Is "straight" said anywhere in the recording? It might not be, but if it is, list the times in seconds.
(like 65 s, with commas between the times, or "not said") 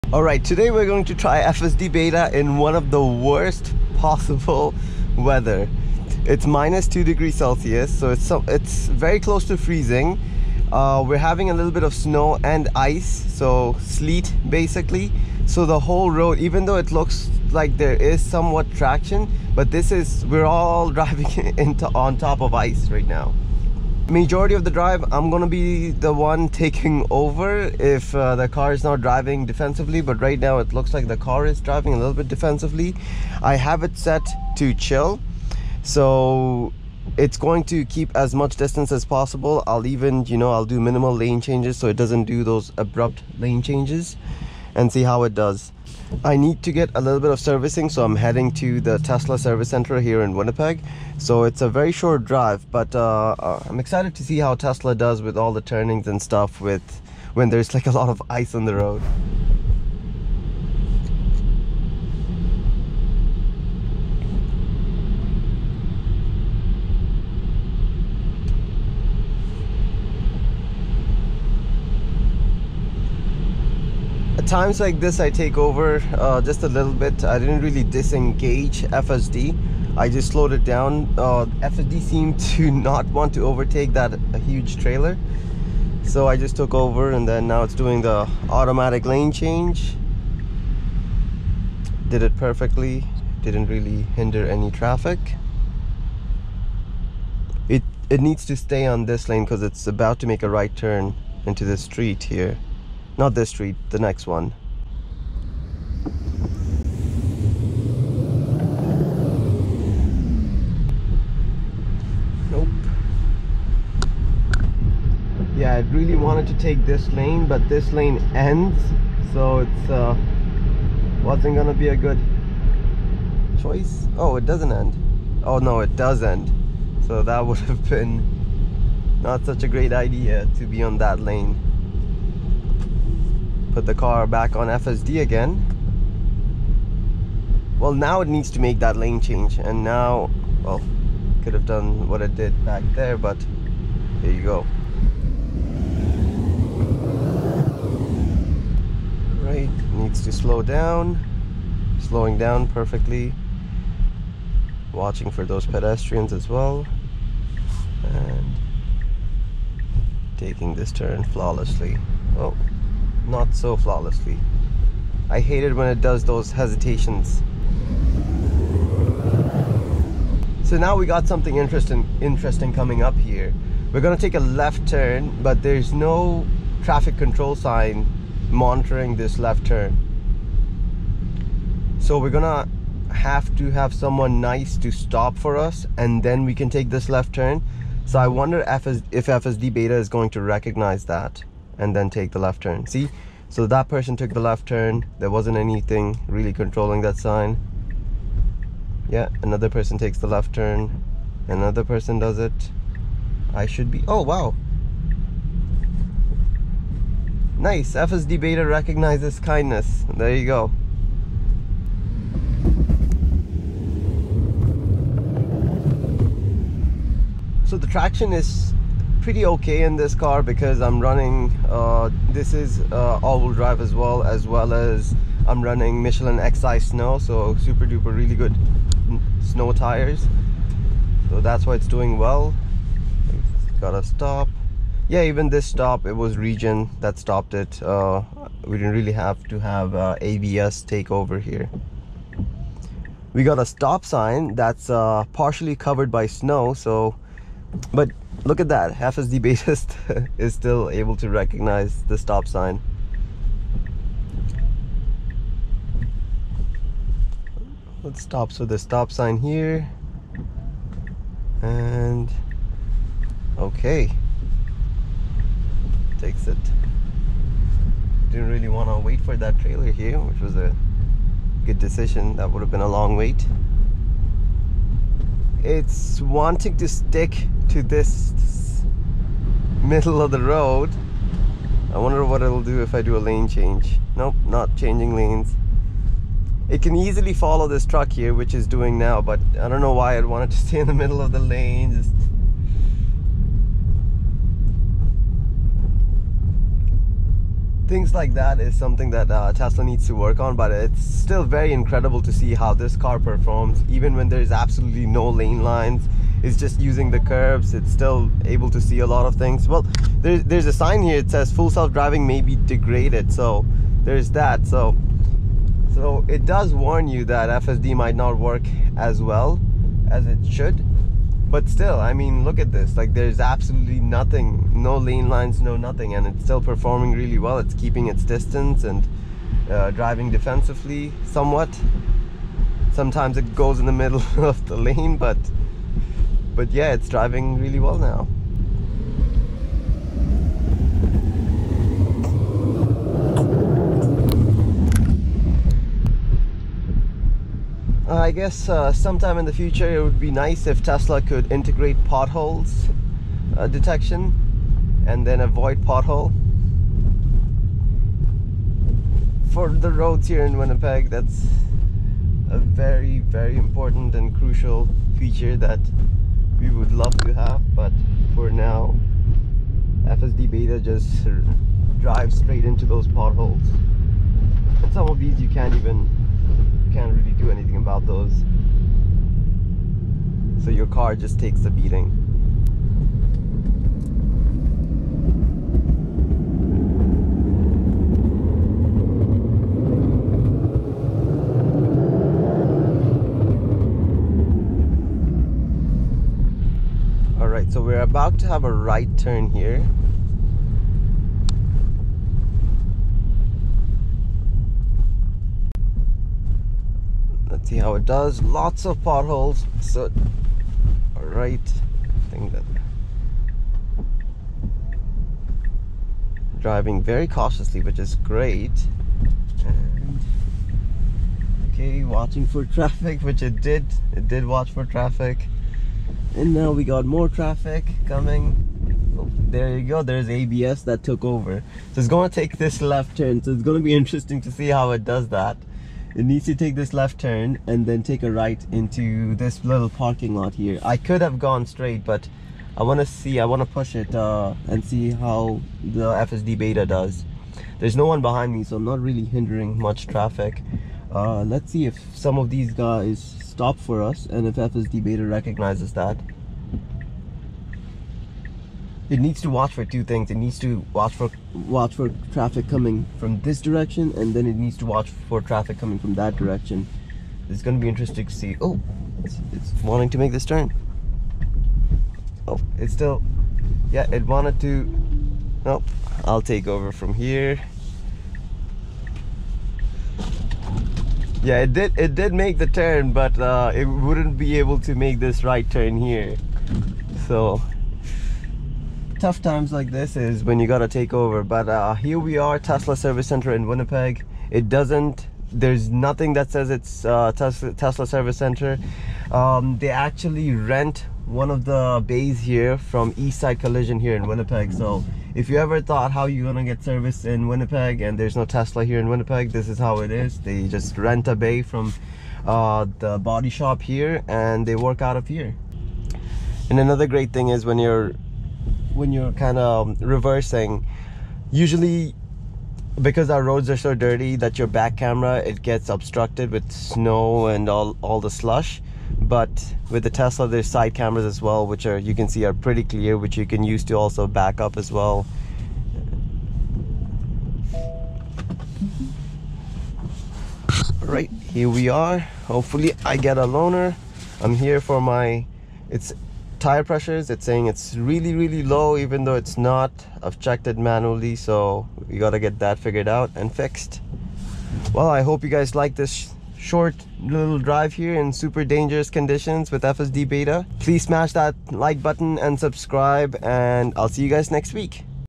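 372 s, 441 s.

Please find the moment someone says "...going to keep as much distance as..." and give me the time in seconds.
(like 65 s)
37 s.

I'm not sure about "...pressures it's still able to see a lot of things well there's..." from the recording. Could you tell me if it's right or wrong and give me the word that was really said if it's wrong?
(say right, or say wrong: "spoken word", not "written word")
wrong: "curves", not "pressures".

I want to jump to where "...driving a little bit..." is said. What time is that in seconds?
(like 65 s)
31 s.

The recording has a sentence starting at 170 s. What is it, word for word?
So now we got something interesting, interesting coming up here.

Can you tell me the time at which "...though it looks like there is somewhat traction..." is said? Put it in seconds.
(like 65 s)
16 s.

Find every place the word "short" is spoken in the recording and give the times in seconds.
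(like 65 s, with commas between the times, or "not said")
51 s, 556 s.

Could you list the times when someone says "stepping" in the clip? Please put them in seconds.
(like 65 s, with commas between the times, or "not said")
not said.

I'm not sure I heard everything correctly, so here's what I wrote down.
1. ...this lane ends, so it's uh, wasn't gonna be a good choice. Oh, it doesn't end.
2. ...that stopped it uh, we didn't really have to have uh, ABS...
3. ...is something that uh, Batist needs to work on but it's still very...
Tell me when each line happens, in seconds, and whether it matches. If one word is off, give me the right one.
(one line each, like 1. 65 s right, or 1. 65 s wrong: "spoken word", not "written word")
1. 117 s right
2. 236 s right
3. 298 s wrong: "Tesla", not "Batist".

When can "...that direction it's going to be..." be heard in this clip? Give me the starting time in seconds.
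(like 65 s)
466 s.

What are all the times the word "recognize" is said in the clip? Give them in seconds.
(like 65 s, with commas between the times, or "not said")
190 s, 208 s, 251 s, 455 s.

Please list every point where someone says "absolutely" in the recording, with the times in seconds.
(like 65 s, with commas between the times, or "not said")
304 s, 323 s.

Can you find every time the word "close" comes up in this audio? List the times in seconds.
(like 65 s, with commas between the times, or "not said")
9 s.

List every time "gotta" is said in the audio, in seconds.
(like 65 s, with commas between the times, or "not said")
233 s, 490 s, 552 s.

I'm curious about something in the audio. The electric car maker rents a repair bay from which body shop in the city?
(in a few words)
Eastside Collision.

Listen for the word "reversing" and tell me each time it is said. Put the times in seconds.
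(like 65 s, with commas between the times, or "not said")
520 s.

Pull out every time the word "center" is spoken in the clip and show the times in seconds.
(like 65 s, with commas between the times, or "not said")
49 s, 493 s, 498 s.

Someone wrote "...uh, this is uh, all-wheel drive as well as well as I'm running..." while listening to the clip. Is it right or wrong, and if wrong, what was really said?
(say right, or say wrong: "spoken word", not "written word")
right.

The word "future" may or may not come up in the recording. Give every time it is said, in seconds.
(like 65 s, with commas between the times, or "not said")
349 s.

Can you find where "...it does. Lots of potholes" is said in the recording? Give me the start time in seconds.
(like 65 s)
407 s.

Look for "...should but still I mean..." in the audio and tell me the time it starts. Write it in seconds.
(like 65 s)
320 s.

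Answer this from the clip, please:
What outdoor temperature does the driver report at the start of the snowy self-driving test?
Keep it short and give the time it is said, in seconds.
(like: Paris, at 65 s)
-2 degrees Celsius, at 6 s.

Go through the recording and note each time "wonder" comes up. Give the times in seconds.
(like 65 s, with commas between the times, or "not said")
188 s, 281 s.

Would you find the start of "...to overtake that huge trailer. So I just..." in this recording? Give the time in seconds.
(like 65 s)
83 s.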